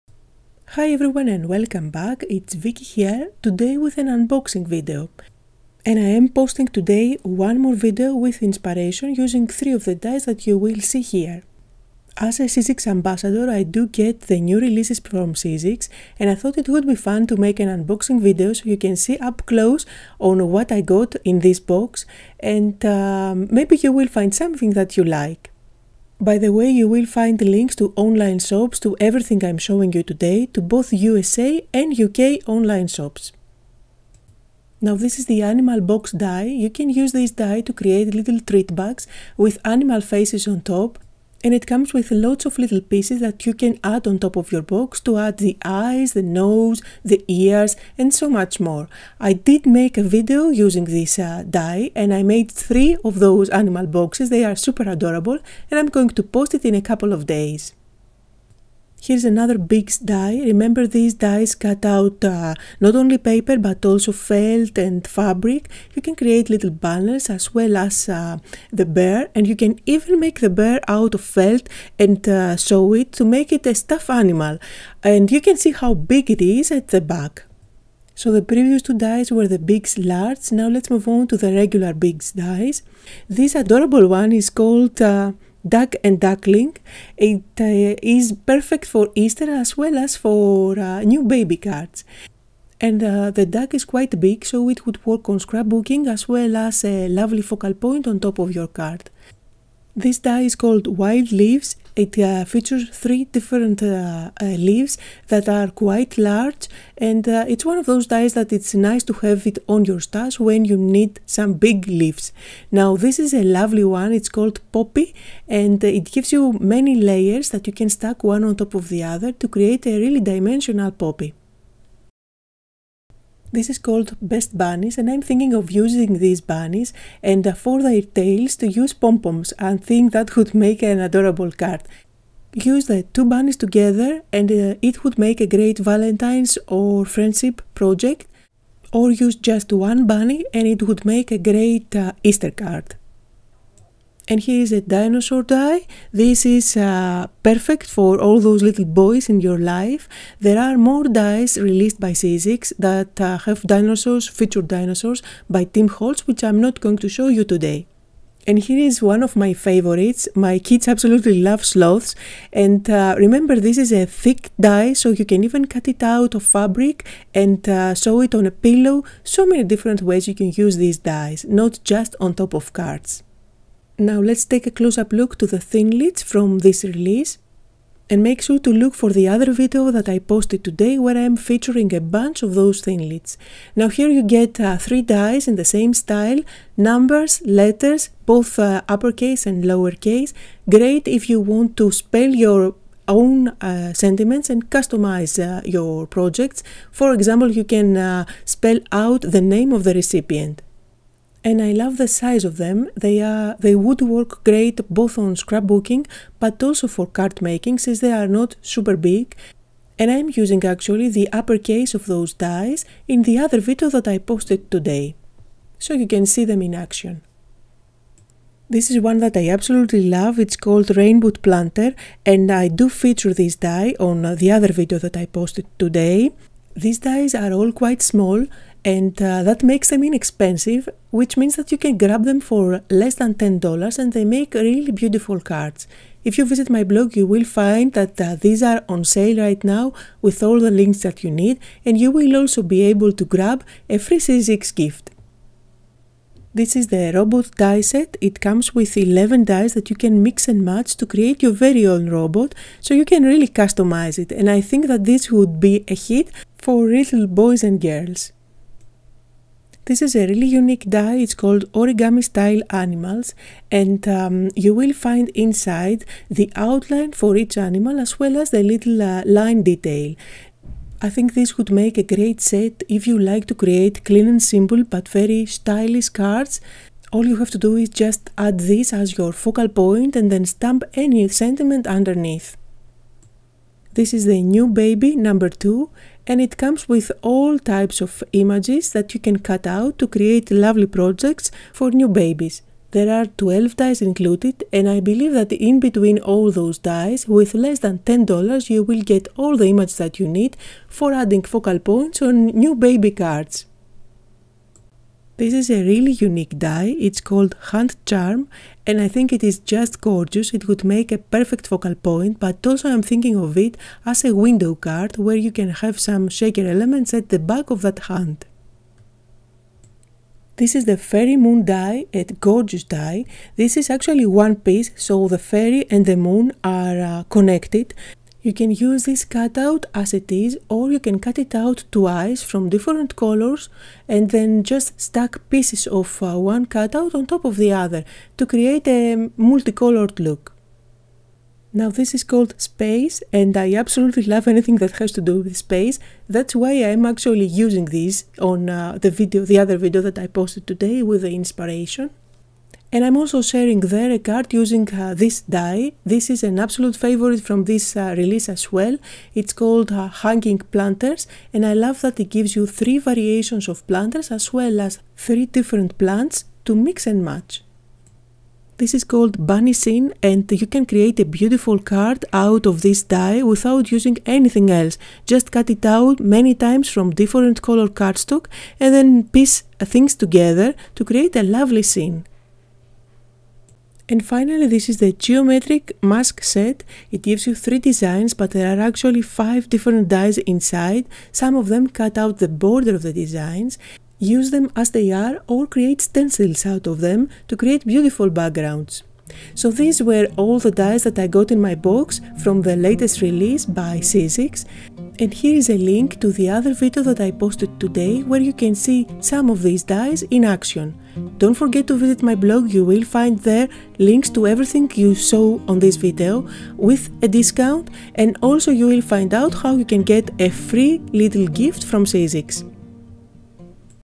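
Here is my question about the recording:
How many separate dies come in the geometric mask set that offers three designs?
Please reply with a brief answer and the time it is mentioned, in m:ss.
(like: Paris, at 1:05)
5, at 6:29.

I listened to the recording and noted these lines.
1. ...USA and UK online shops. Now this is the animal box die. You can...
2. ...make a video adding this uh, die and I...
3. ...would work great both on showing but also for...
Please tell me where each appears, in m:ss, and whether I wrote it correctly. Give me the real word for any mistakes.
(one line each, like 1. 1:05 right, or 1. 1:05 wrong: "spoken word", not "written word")
1. 0:30 right
2. 0:49 wrong: "using", not "adding"
3. 3:23 wrong: "scrapbooking", not "showing".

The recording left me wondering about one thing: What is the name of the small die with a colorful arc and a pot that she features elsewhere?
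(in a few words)
Rainbow Planter.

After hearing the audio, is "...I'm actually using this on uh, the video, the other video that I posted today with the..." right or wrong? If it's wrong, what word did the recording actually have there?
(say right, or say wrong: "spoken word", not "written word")
right.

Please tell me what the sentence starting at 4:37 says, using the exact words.
All you have to do is just add this as your focal point and then stamp any sentiment underneath.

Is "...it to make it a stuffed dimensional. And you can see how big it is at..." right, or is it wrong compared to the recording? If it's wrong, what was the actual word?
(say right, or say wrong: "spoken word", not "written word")
wrong: "animal", not "dimensional".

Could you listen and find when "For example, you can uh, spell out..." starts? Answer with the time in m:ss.
3:16.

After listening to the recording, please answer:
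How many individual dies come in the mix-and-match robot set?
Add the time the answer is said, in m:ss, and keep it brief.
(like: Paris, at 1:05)
11, at 4:08.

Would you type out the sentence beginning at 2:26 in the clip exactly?
This is uh, perfect for all those little boys in your life.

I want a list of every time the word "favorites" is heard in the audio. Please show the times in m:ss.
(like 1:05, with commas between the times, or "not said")
2:39, 5:57.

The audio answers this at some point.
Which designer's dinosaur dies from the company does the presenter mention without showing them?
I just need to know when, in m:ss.
2:35.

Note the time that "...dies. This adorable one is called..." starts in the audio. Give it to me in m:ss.
1:22.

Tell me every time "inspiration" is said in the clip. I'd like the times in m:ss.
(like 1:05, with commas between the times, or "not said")
0:08, 5:51.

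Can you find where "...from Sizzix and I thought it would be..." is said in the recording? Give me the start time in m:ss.
0:15.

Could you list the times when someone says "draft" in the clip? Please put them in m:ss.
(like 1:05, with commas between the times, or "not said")
not said.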